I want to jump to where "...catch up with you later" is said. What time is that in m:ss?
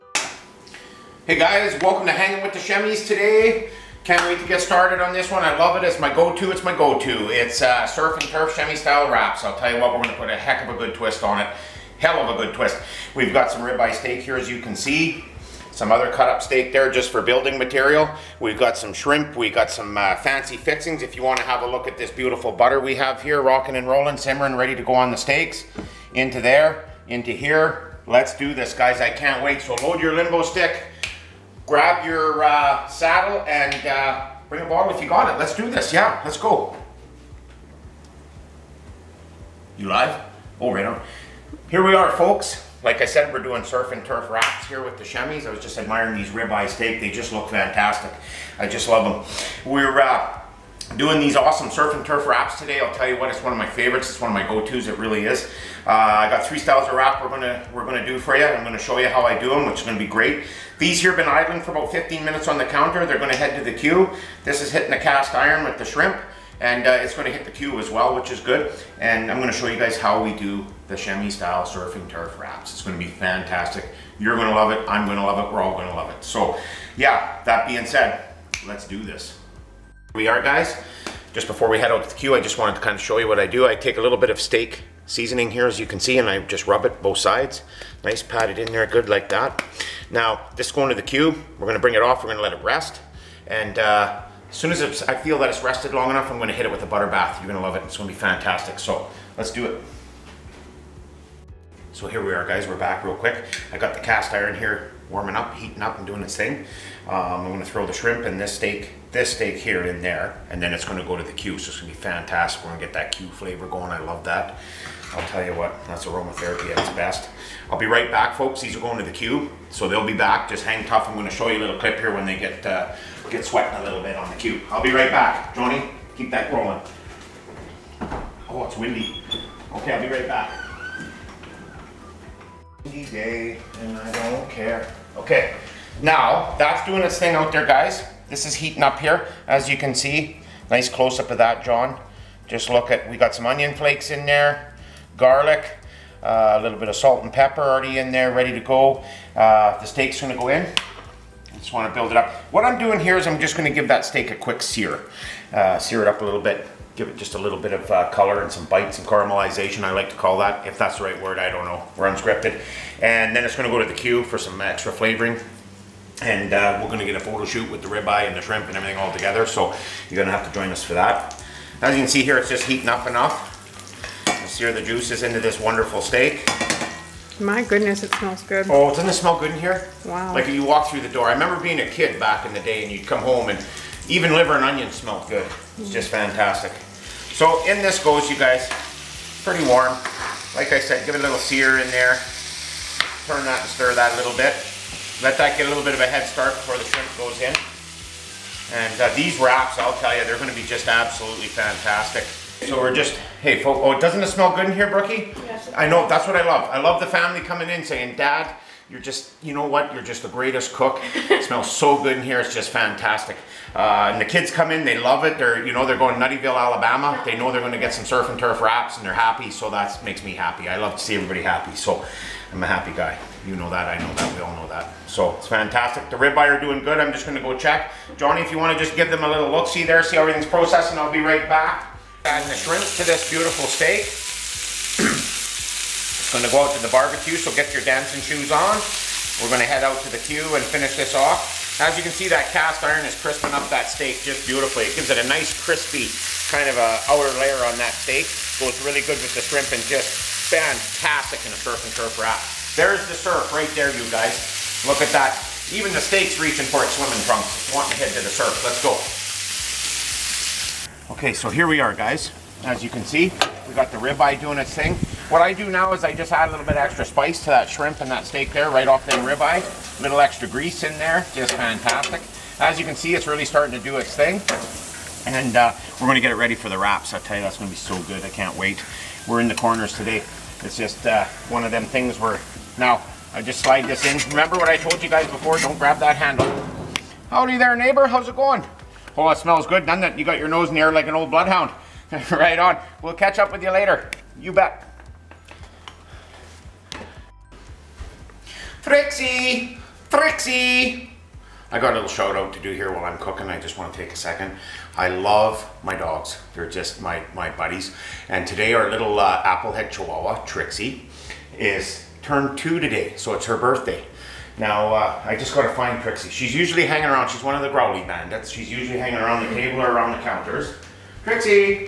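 4:53.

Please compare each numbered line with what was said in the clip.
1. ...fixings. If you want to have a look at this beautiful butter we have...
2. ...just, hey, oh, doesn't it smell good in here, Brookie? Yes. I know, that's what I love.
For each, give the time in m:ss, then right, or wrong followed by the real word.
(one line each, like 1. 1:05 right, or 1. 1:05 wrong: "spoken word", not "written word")
1. 0:20 right
2. 3:22 right.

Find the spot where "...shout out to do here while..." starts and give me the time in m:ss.
5:02.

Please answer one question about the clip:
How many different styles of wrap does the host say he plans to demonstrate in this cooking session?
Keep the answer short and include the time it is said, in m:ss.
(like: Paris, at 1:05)
3, at 0:56.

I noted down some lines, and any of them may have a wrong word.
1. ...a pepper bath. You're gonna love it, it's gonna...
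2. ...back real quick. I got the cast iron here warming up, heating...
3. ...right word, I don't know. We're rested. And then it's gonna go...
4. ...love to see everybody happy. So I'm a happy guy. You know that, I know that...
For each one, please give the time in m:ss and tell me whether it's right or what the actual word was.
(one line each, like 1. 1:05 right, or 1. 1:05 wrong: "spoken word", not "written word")
1. 1:36 wrong: "butter", not "pepper"
2. 1:42 right
3. 2:41 wrong: "unscripted", not "rested"
4. 3:40 right.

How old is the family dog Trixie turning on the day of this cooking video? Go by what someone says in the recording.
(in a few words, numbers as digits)
2.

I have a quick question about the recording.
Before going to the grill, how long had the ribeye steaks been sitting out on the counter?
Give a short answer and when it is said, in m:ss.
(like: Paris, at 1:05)
15 minutes, at 1:01.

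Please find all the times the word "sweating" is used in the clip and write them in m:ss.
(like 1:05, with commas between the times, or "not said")
2:03.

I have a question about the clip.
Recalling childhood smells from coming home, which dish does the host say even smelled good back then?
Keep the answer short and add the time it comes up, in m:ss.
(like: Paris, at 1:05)
liver and onion, at 3:04.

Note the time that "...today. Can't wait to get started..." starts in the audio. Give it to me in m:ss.
0:03.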